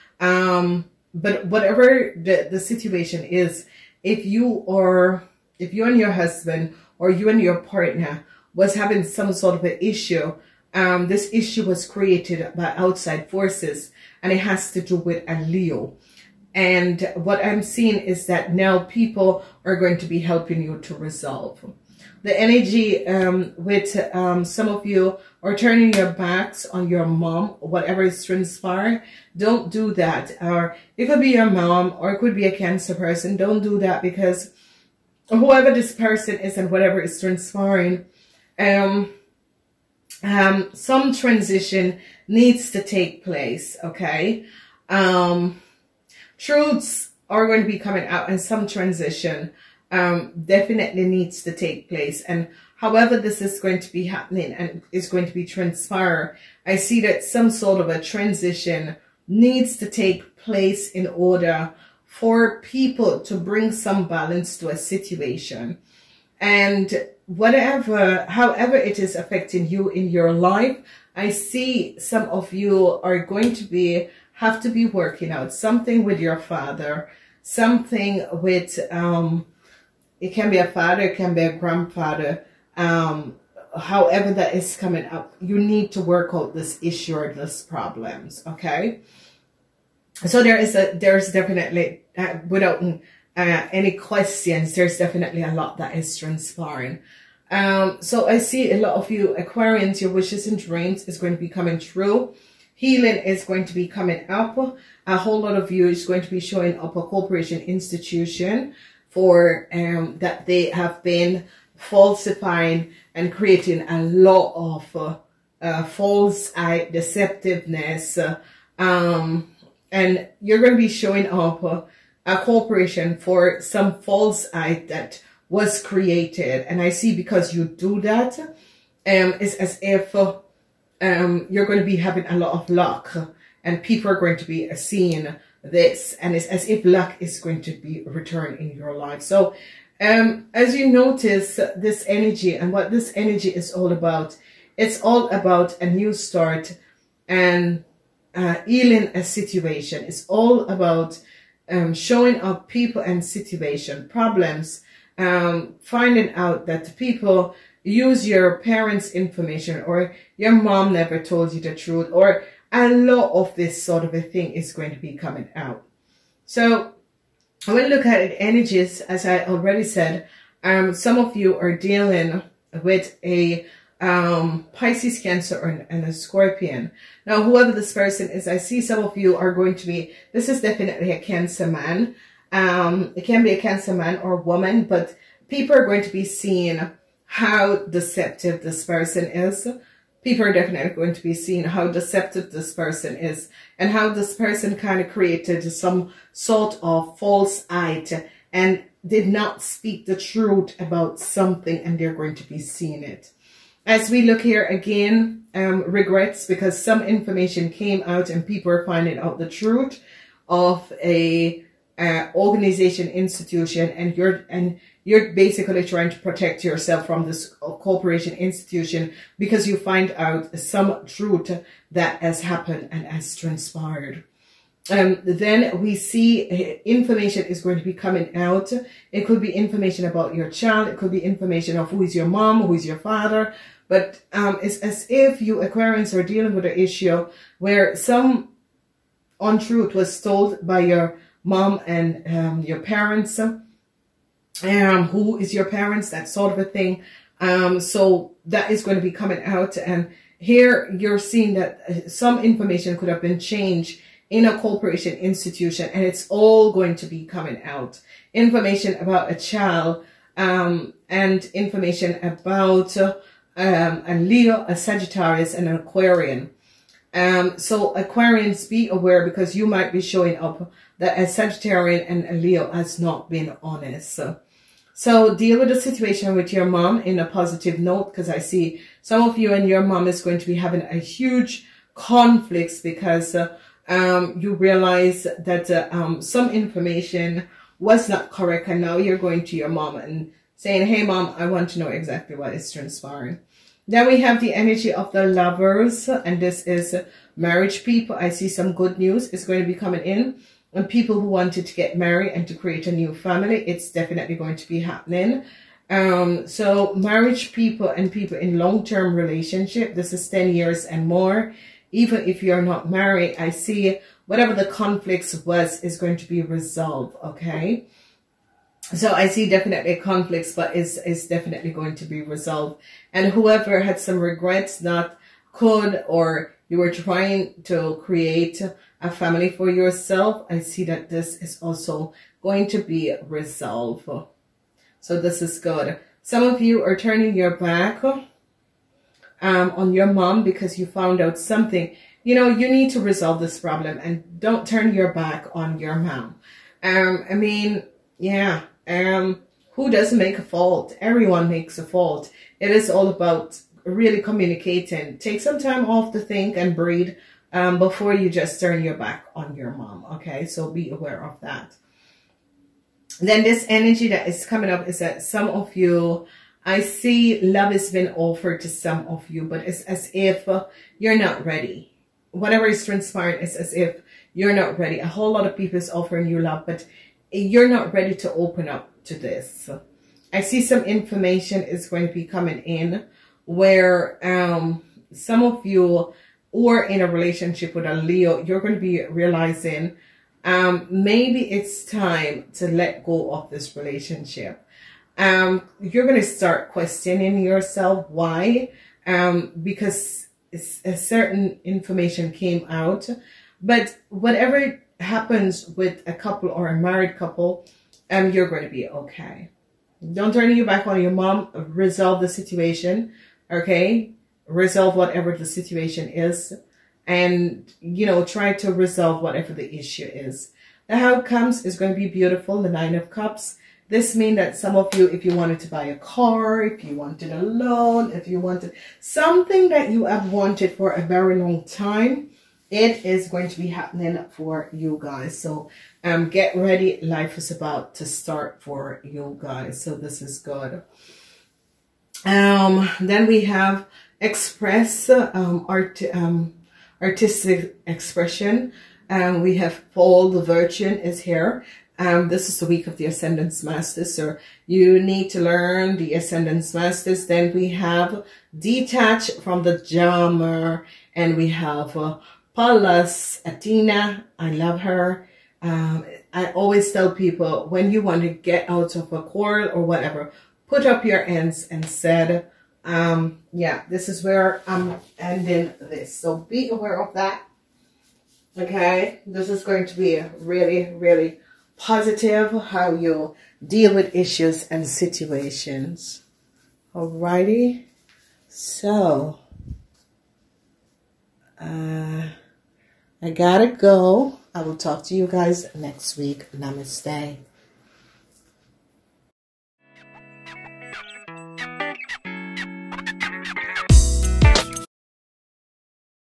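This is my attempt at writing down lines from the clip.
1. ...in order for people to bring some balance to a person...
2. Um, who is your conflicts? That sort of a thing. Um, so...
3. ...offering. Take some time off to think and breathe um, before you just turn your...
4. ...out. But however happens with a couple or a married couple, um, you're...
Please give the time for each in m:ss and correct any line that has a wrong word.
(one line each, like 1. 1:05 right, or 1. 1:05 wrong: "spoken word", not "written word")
1. 1:00 wrong: "situation", not "person"
2. 4:03 wrong: "parents", not "conflicts"
3. 5:54 wrong: "communicating", not "offering"
4. 6:42 wrong: "whatever", not "however".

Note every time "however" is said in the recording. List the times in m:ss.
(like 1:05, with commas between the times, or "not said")
0:52, 1:08, 1:23.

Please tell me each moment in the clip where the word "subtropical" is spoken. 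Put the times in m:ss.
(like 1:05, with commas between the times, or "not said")
not said.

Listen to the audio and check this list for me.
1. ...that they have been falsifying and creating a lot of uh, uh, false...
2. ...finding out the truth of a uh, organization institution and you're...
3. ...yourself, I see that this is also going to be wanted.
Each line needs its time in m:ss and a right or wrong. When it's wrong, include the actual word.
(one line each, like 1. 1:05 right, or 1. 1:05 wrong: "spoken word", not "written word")
1. 1:50 right
2. 3:28 right
3. 5:29 wrong: "resolved", not "wanted".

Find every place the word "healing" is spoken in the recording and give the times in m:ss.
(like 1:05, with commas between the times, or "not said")
1:42, 2:28.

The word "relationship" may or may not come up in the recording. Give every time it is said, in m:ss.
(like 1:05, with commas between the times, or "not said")
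5:09, 6:27, 6:33.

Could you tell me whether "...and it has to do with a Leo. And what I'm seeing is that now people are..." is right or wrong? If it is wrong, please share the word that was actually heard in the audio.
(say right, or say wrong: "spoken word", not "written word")
right.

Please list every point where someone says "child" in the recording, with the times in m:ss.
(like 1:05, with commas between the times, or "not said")
3:50, 4:19.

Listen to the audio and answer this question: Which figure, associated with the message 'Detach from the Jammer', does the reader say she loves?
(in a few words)
Pallas Athena.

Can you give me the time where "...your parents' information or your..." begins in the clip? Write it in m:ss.
2:38.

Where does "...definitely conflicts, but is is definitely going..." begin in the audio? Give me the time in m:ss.
5:19.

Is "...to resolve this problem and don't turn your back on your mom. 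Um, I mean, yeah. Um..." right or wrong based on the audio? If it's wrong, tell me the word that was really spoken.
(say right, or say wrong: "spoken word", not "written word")
right.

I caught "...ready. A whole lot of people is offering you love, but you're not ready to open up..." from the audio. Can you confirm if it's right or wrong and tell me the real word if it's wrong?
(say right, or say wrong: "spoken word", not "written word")
right.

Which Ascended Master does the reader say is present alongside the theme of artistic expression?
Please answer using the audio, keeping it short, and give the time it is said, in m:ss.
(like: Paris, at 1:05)
Paul the Venetian, at 7:29.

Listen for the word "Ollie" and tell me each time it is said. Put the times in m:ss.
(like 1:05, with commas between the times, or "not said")
not said.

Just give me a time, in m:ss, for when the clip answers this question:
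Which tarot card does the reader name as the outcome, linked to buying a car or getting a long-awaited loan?
7:02.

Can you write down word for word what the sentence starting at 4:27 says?
Um, so Aquarians, be aware because you might be showing up that a Sagittarian and a Leo has not been honest.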